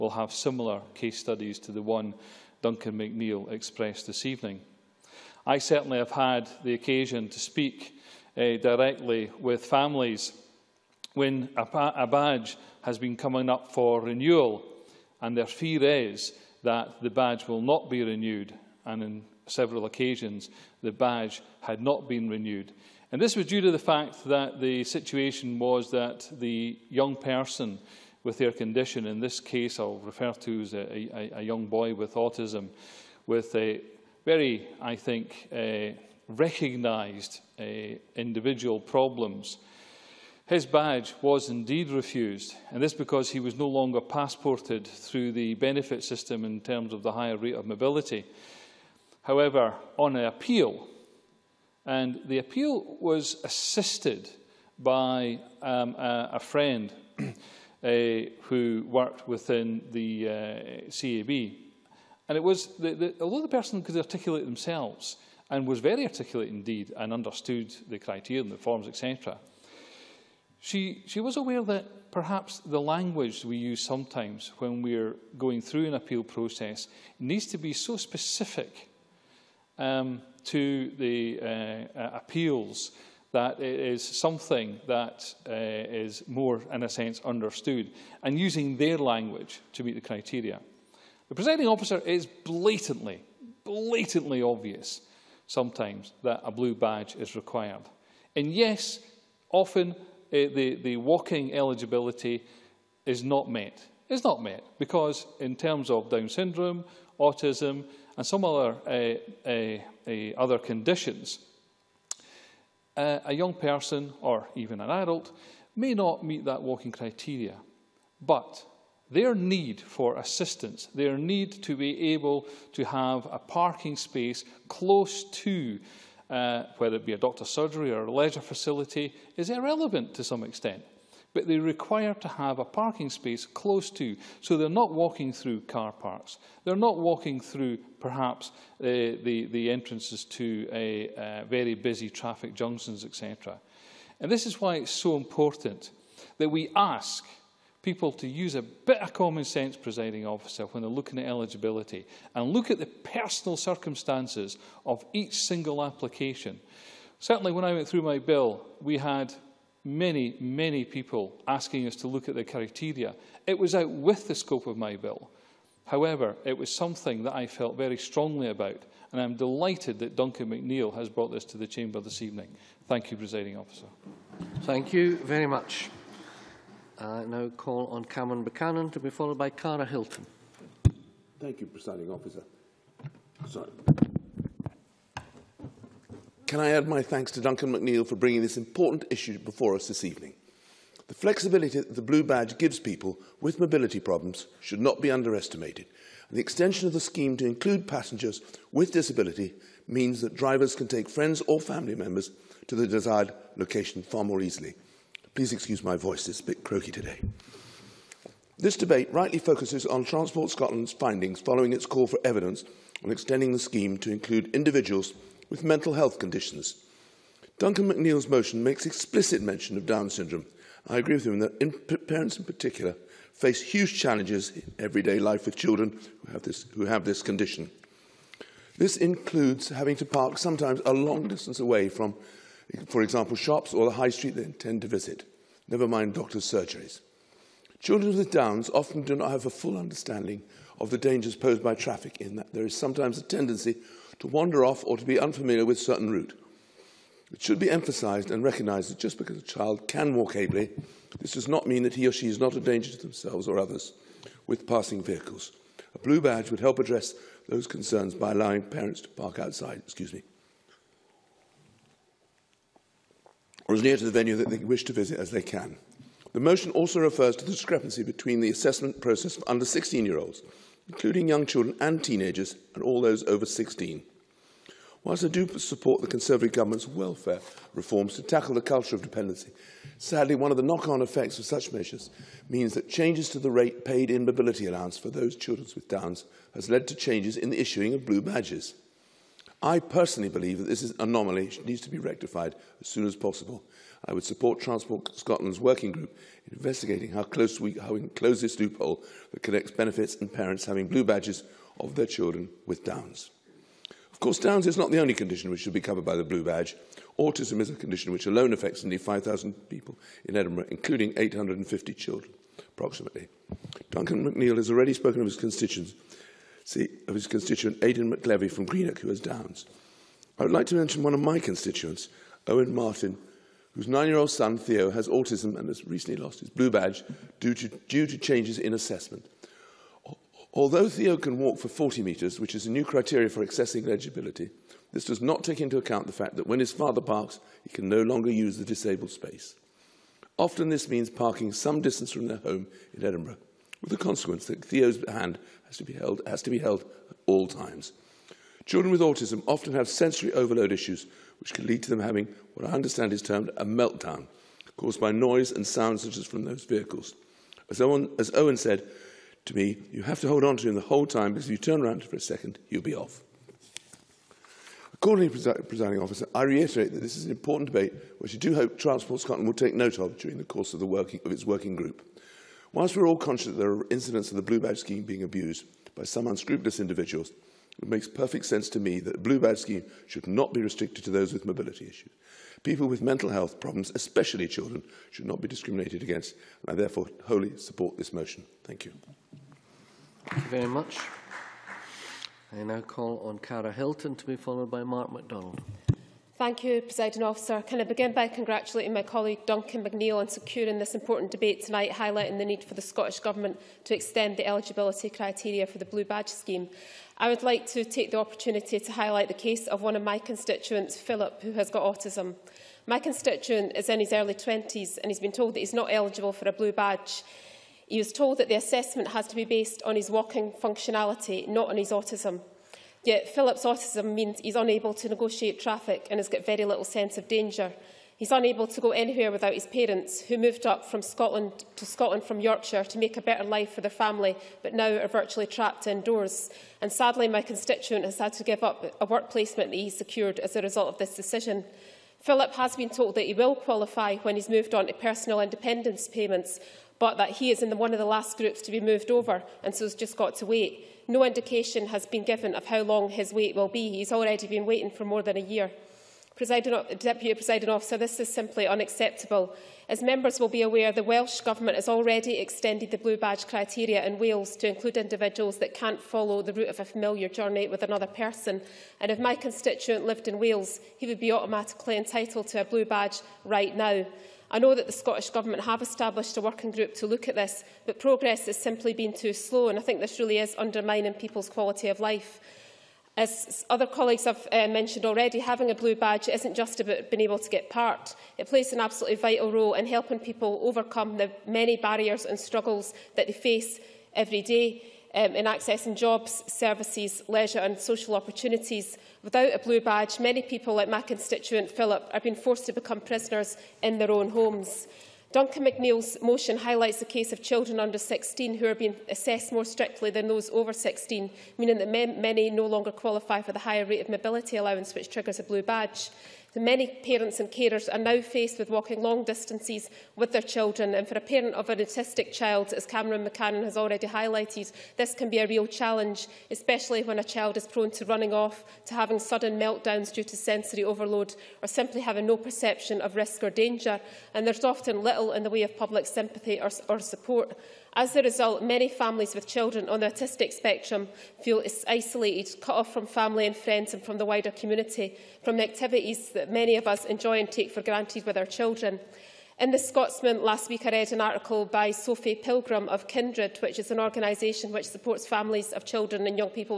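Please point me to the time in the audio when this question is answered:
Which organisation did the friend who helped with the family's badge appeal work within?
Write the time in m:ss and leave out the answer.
1:00.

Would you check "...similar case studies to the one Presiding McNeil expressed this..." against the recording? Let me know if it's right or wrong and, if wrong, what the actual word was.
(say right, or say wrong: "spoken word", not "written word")
wrong: "Duncan", not "Presiding".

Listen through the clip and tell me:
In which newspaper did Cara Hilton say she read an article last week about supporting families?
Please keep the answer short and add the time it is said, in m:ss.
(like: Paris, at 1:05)
The Scotsman, at 9:09.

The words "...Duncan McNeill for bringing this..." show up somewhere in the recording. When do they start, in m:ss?
3:07.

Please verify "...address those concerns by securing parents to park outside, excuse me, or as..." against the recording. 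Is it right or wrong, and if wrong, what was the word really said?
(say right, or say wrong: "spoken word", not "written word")
wrong: "allowing", not "securing".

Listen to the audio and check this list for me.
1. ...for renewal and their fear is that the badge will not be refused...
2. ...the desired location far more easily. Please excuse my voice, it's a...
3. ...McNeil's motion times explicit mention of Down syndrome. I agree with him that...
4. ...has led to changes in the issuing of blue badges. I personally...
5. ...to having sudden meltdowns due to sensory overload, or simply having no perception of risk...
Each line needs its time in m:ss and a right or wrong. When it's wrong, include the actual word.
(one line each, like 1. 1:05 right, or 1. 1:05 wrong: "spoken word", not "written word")
1. 0:13 wrong: "renewed", not "refused"
2. 3:22 right
3. 3:37 wrong: "makes", not "times"
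4. 4:46 right
5. 8:48 right.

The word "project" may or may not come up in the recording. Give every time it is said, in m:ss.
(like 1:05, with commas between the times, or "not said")
not said.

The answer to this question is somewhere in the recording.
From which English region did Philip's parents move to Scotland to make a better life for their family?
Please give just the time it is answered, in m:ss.
7:12.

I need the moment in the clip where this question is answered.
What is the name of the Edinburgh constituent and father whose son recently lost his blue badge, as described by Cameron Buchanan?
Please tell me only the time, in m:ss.
5:22.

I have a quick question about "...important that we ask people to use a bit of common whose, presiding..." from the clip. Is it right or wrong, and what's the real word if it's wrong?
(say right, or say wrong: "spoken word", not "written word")
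wrong: "sense", not "whose".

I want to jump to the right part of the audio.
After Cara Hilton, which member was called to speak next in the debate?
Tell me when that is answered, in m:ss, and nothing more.
6:34.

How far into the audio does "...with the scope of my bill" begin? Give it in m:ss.
2:43.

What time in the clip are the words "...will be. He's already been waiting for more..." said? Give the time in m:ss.
7:33.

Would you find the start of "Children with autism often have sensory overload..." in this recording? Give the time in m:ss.
5:48.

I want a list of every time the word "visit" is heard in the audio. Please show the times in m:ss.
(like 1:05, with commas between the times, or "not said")
3:54, 4:24.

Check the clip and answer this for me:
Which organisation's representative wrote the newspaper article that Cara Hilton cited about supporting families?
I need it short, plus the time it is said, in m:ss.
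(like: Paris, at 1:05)
Kindred, at 9:13.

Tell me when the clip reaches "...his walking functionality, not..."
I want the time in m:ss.
6:59.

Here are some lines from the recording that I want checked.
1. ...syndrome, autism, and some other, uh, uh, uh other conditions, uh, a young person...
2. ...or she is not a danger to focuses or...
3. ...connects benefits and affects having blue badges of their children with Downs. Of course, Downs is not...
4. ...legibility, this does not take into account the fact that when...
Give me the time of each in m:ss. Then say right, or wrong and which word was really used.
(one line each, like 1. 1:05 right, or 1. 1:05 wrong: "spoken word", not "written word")
1. 1:46 right
2. 4:12 wrong: "themselves", not "focuses"
3. 4:59 wrong: "parents", not "affects"
4. 5:33 right.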